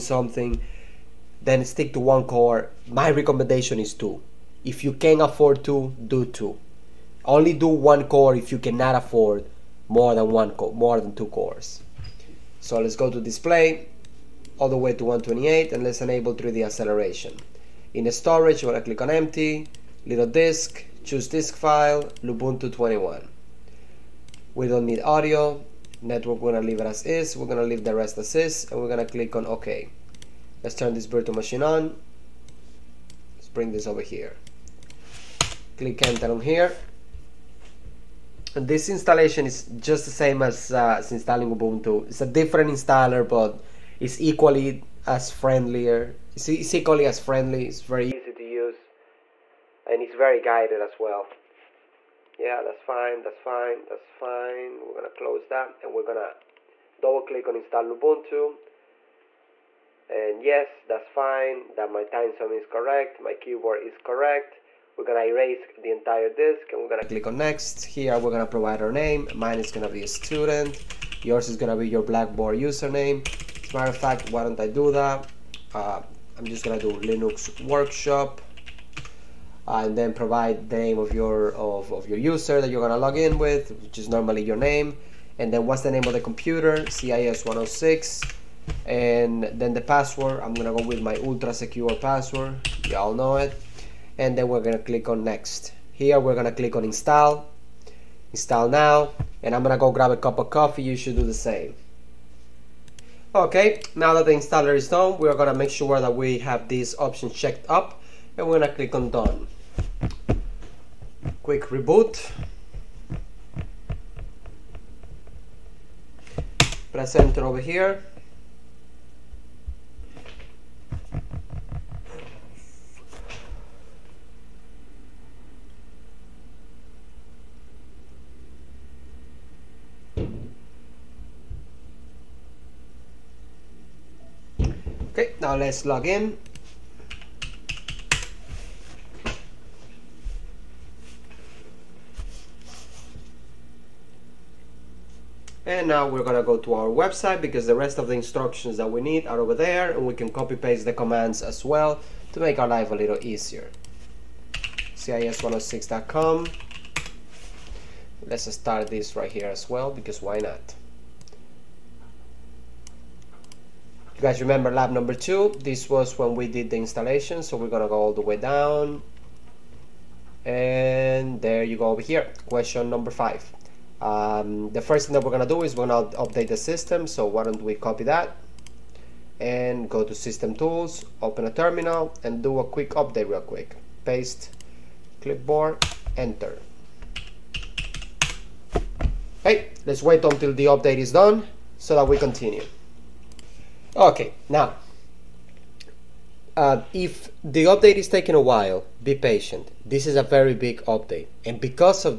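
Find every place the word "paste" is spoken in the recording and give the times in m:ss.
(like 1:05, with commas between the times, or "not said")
2:30, 3:04.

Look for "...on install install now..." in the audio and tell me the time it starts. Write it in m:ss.
1:36.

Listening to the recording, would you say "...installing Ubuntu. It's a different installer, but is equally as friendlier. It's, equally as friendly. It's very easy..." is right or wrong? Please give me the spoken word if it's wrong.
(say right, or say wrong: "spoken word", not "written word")
right.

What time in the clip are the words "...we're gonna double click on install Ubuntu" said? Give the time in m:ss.
0:55.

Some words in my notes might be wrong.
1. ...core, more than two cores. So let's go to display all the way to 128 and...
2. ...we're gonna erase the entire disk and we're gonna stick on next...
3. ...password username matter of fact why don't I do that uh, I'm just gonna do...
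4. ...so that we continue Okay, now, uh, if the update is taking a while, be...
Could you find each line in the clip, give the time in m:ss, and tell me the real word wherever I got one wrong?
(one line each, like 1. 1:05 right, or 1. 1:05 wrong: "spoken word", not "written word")
1. 0:10 right
2. 1:04 wrong: "click", not "stick"
3. 1:12 wrong: "blackboard", not "password"
4. 3:11 right.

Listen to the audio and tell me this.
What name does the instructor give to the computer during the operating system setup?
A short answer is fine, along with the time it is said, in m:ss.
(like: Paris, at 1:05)
CIS 106, at 1:26.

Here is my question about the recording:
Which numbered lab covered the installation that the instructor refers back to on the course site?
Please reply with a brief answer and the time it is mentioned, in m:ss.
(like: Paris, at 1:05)
2, at 2:44.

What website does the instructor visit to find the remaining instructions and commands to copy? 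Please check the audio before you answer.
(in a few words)
cis106.com.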